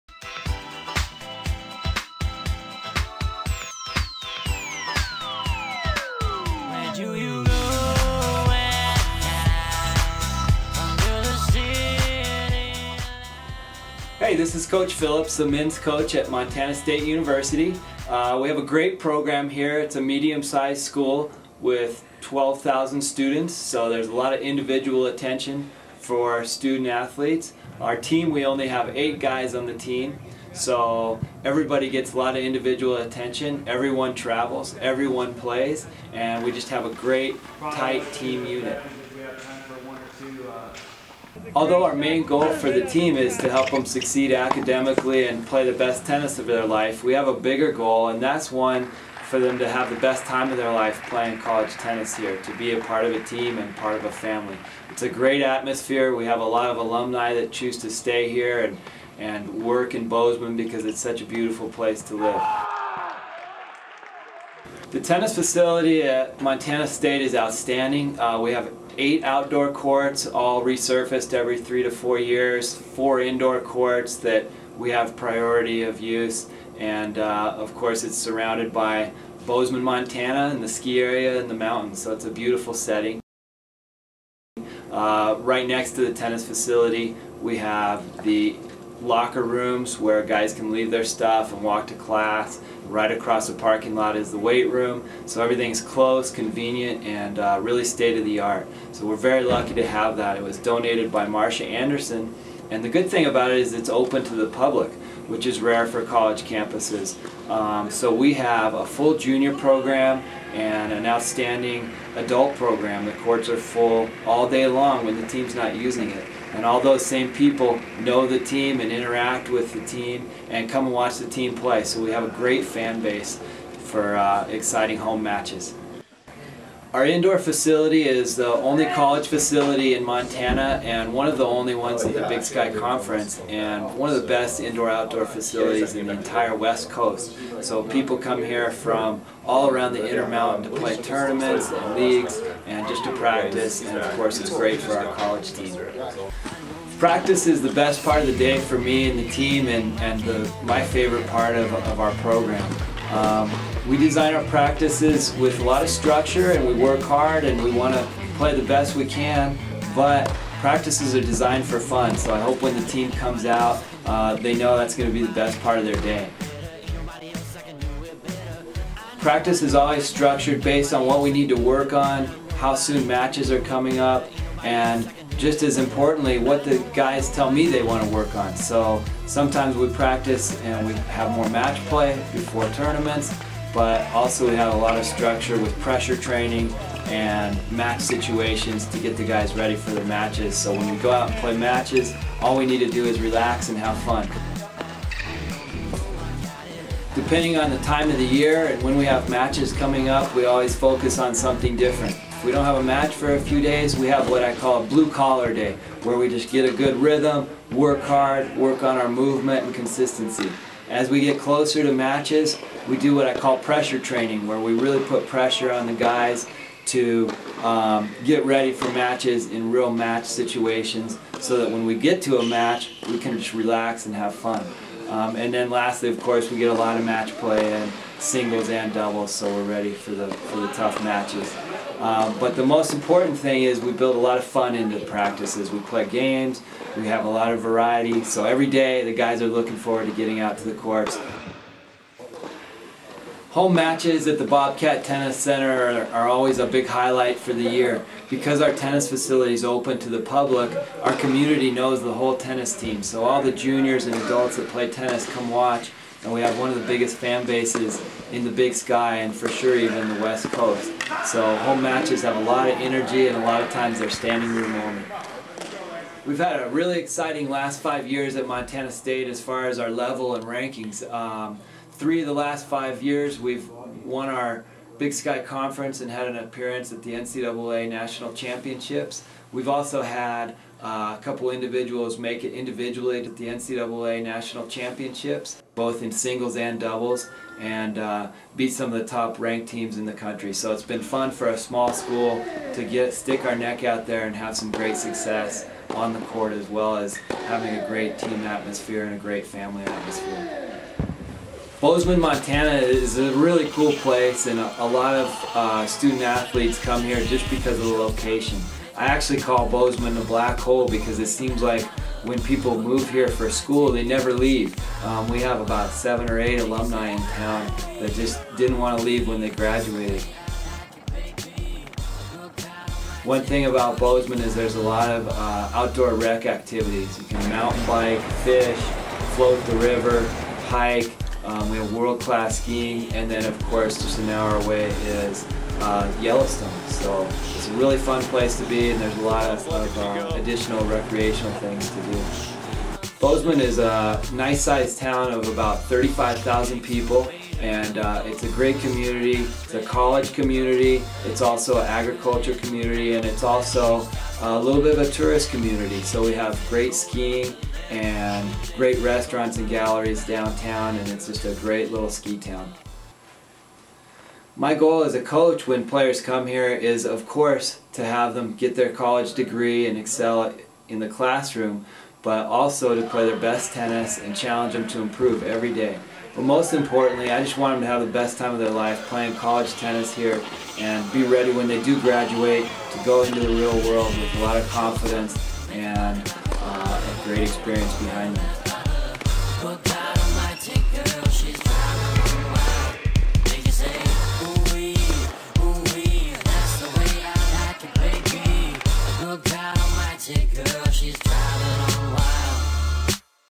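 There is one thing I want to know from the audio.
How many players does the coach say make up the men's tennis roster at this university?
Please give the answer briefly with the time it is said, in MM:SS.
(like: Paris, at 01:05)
8, at 00:28.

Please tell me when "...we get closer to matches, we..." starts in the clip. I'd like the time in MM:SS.
03:31.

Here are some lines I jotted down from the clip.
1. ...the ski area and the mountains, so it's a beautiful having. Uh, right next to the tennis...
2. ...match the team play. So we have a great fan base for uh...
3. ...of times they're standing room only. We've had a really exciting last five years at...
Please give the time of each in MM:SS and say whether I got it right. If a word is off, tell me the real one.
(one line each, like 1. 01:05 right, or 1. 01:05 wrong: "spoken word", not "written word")
1. 01:20 wrong: "setting", not "having"
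2. 02:00 wrong: "watch", not "match"
3. 04:23 right.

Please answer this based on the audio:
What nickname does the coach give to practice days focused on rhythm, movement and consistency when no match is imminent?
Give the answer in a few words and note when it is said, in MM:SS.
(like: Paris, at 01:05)
Blue collar day, at 03:24.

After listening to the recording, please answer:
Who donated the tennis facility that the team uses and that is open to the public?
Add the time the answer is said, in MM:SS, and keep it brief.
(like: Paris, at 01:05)
Marcia Anderson, at 01:41.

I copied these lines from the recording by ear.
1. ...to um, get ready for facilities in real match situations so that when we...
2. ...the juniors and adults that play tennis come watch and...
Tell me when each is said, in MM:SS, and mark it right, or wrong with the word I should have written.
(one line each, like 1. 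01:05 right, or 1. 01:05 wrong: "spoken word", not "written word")
1. 03:36 wrong: "matches", not "facilities"
2. 04:13 right.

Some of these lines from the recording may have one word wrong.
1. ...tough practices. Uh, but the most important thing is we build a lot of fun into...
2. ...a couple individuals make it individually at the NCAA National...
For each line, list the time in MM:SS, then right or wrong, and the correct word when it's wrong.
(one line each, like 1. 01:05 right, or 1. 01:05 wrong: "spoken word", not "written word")
1. 03:50 wrong: "matches", not "practices"
2. 04:41 right.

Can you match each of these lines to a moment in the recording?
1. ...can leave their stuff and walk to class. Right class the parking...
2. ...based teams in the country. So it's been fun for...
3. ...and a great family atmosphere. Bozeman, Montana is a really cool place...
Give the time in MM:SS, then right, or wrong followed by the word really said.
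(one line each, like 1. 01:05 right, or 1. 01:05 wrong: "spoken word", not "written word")
1. 01:30 wrong: "across", not "class"
2. 04:49 wrong: "ranked", not "based"
3. 04:59 right.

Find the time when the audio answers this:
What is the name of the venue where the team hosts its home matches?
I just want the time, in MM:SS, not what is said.
04:04.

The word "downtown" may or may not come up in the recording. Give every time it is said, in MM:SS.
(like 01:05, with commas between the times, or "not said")
06:00.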